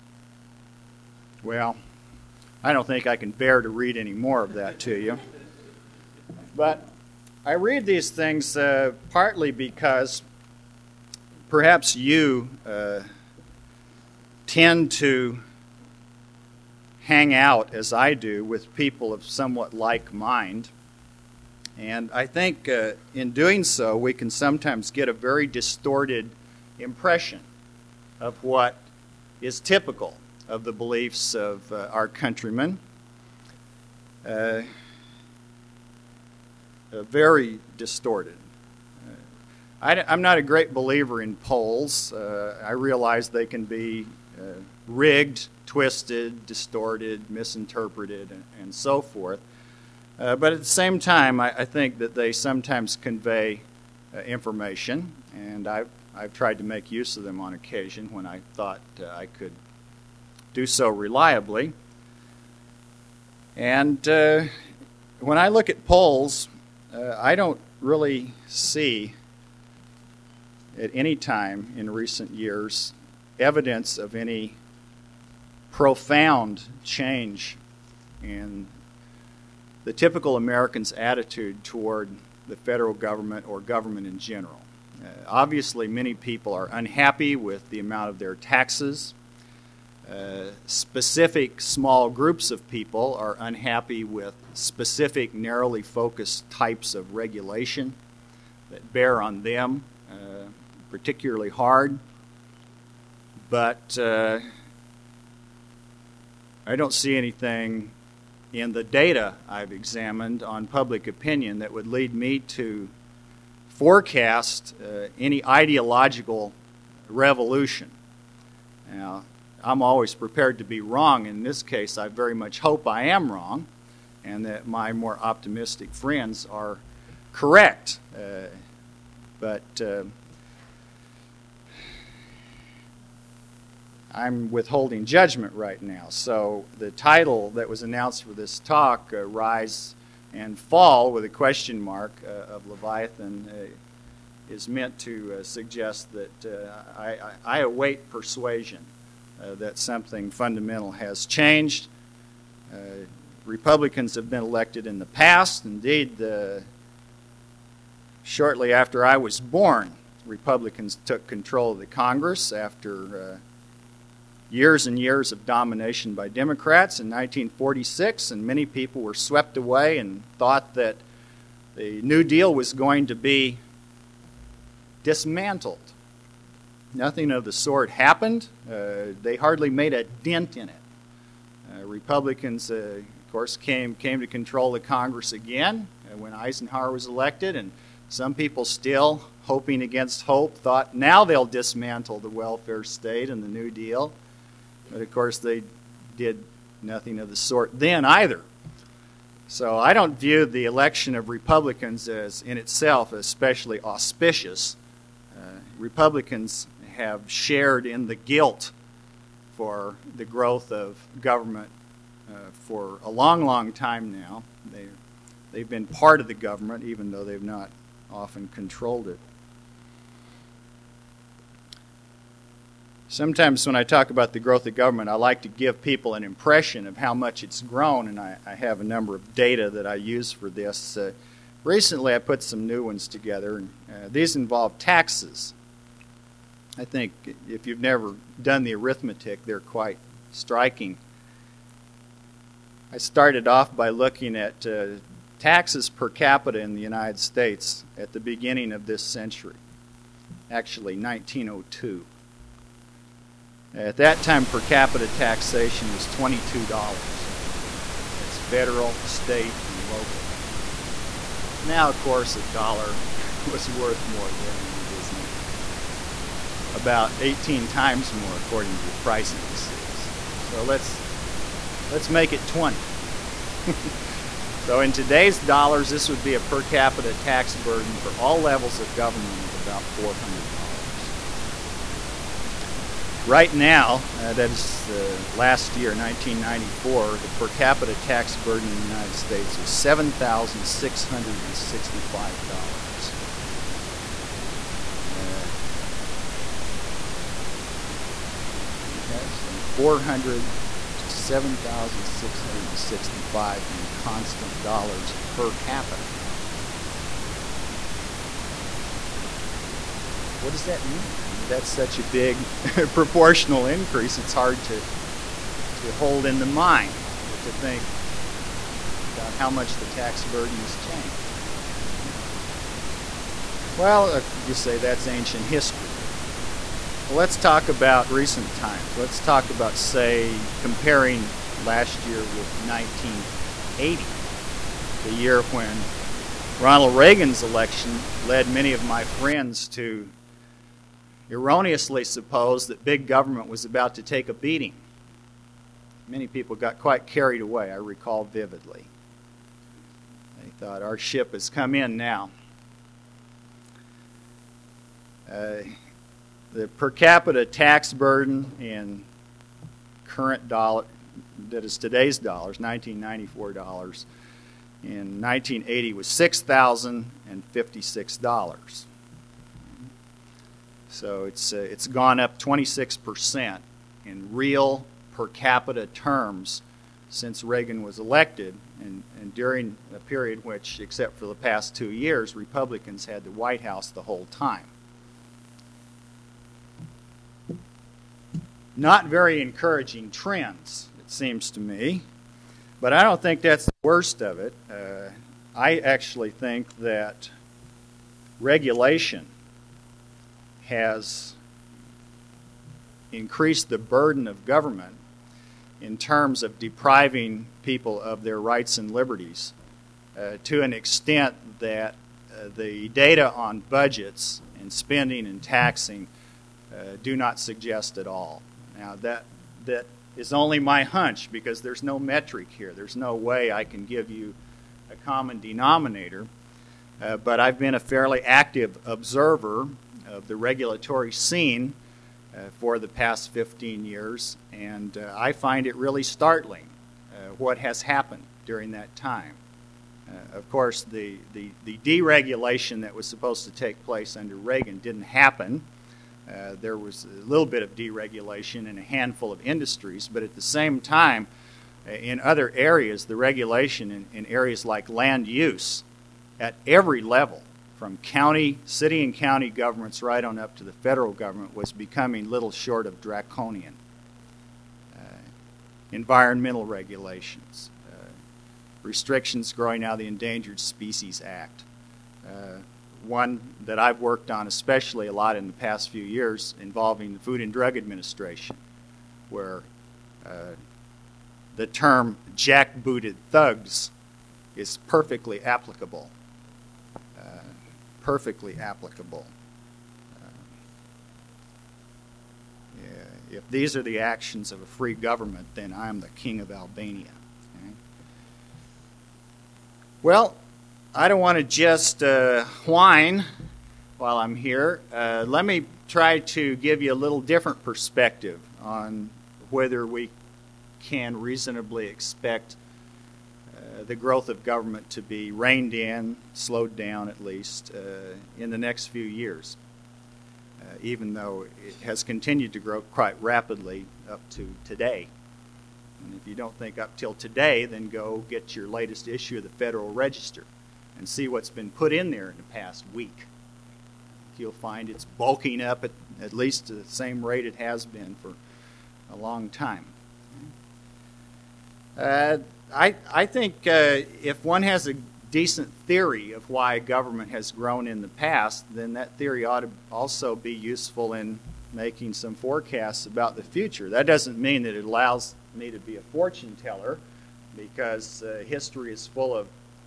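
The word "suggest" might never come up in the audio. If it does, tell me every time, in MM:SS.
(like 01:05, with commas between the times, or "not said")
02:25, 06:57.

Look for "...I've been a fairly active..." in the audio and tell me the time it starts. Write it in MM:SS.
07:07.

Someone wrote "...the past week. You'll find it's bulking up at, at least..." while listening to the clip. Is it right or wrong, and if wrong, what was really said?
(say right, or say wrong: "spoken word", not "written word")
right.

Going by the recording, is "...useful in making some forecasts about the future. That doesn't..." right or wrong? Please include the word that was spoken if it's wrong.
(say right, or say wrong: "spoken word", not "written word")
right.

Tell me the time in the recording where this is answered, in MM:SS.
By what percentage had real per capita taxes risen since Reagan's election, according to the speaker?
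06:12.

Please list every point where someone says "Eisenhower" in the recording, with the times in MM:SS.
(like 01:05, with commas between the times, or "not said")
03:06.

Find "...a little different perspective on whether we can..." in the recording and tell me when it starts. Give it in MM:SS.
08:26.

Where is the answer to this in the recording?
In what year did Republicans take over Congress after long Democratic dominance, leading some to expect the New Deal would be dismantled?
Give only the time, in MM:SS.
02:47.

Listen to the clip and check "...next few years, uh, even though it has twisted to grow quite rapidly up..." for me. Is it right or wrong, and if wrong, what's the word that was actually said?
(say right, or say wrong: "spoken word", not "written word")
wrong: "continued", not "twisted".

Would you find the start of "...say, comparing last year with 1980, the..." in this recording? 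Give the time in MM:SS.
05:29.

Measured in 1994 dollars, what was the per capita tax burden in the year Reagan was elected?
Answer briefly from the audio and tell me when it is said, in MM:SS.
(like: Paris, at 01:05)
$6,056, at 06:06.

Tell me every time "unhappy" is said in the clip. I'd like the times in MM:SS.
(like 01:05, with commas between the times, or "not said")
01:26, 01:33.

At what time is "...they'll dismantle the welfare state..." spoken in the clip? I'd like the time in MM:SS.
03:11.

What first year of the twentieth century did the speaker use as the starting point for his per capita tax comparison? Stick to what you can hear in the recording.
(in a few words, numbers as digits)
1902.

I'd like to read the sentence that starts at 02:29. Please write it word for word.
Uh, that something fundamental has changed.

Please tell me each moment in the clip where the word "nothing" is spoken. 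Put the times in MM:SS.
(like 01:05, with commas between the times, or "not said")
02:56, 03:16.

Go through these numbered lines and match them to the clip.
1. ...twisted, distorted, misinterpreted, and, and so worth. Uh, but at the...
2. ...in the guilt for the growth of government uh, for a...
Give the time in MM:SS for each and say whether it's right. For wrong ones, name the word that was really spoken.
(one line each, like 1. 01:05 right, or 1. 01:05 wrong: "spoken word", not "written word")
1. 00:45 wrong: "forth", not "worth"
2. 03:27 right.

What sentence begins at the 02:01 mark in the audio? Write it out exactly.
In this case, I very much hope I am wrong and that my more optimistic friends are correct.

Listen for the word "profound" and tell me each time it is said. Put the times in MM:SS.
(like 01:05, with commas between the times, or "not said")
01:15.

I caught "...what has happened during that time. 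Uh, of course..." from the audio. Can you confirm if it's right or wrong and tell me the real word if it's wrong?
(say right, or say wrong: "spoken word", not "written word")
right.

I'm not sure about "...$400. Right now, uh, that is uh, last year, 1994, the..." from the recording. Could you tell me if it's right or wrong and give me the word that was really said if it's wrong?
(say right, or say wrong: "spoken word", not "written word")
right.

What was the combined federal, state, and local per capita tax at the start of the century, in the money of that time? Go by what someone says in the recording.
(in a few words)
$22.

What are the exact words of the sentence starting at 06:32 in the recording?
But I don't think that's the worst of it.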